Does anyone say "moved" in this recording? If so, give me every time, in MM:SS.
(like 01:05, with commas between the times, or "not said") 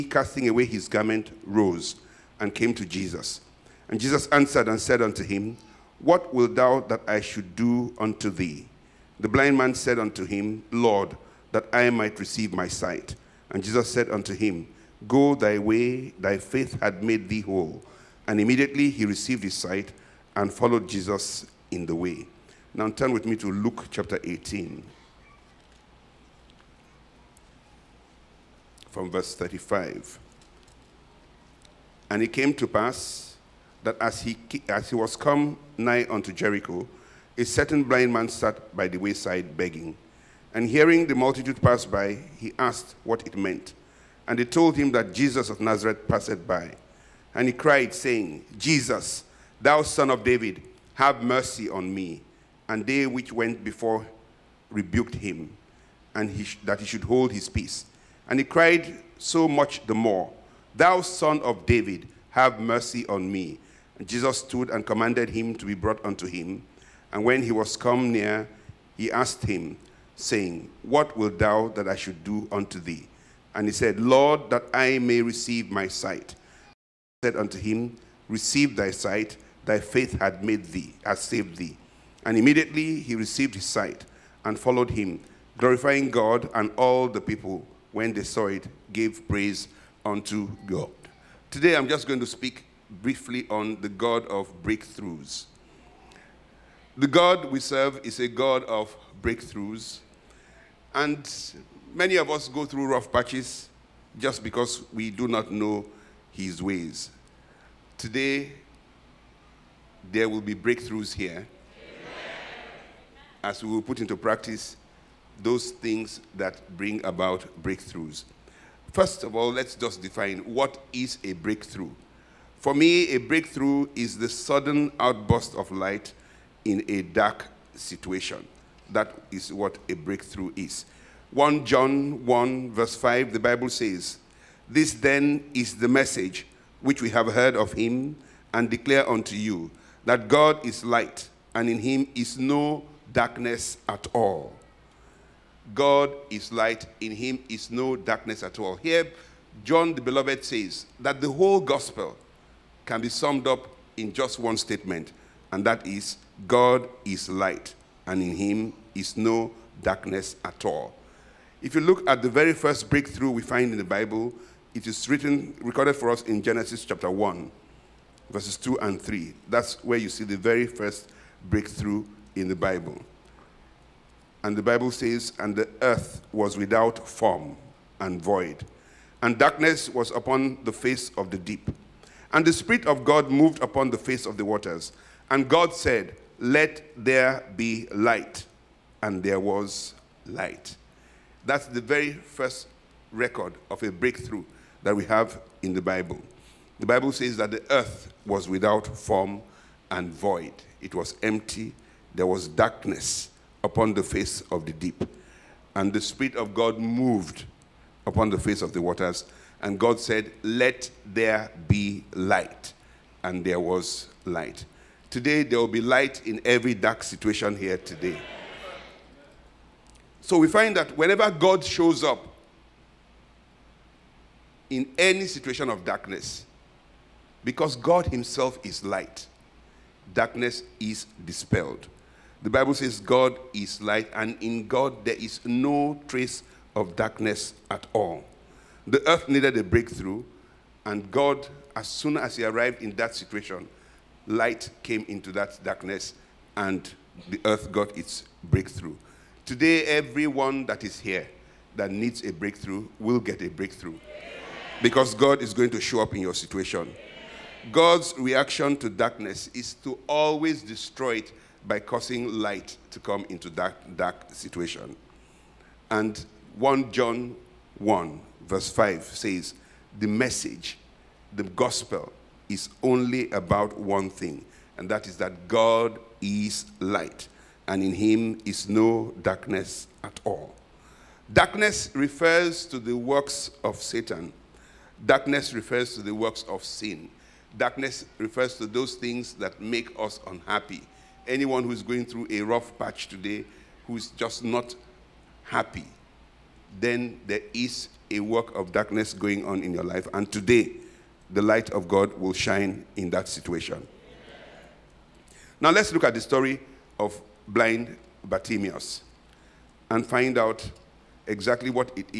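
03:03, 03:26.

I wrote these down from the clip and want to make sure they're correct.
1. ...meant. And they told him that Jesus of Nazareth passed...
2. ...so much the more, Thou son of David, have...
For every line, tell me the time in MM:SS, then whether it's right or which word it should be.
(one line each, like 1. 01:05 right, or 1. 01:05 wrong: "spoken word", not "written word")
1. 00:43 right
2. 00:59 right.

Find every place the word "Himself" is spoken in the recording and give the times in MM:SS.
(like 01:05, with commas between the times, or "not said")
03:48.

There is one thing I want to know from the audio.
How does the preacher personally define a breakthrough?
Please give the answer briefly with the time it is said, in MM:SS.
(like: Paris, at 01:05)
Sudden outburst of light, at 02:04.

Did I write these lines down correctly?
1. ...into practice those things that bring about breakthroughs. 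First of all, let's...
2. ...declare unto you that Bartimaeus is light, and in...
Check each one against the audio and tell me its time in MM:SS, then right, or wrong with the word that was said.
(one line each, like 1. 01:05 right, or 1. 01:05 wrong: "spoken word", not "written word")
1. 01:53 right
2. 02:18 wrong: "God", not "Bartimaeus".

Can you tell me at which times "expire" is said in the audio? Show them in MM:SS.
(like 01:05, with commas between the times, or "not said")
not said.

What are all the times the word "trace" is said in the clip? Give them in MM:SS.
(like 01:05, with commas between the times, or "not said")
03:56.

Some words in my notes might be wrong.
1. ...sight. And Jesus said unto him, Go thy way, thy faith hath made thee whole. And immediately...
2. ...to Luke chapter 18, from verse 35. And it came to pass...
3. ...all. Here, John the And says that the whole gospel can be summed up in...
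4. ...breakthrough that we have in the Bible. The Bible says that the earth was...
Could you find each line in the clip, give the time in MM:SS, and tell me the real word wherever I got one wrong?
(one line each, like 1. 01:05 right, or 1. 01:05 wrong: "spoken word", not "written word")
1. 00:12 right
2. 00:23 right
3. 02:28 wrong: "Beloved", not "And"
4. 03:13 right.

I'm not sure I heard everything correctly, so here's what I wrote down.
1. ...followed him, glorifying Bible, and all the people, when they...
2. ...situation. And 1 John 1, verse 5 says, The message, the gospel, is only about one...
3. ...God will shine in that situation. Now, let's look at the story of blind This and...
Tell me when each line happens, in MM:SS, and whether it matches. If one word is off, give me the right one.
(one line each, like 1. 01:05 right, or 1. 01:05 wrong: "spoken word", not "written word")
1. 01:24 wrong: "God", not "Bible"
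2. 04:24 right
3. 05:01 wrong: "Bartimaeus", not "This".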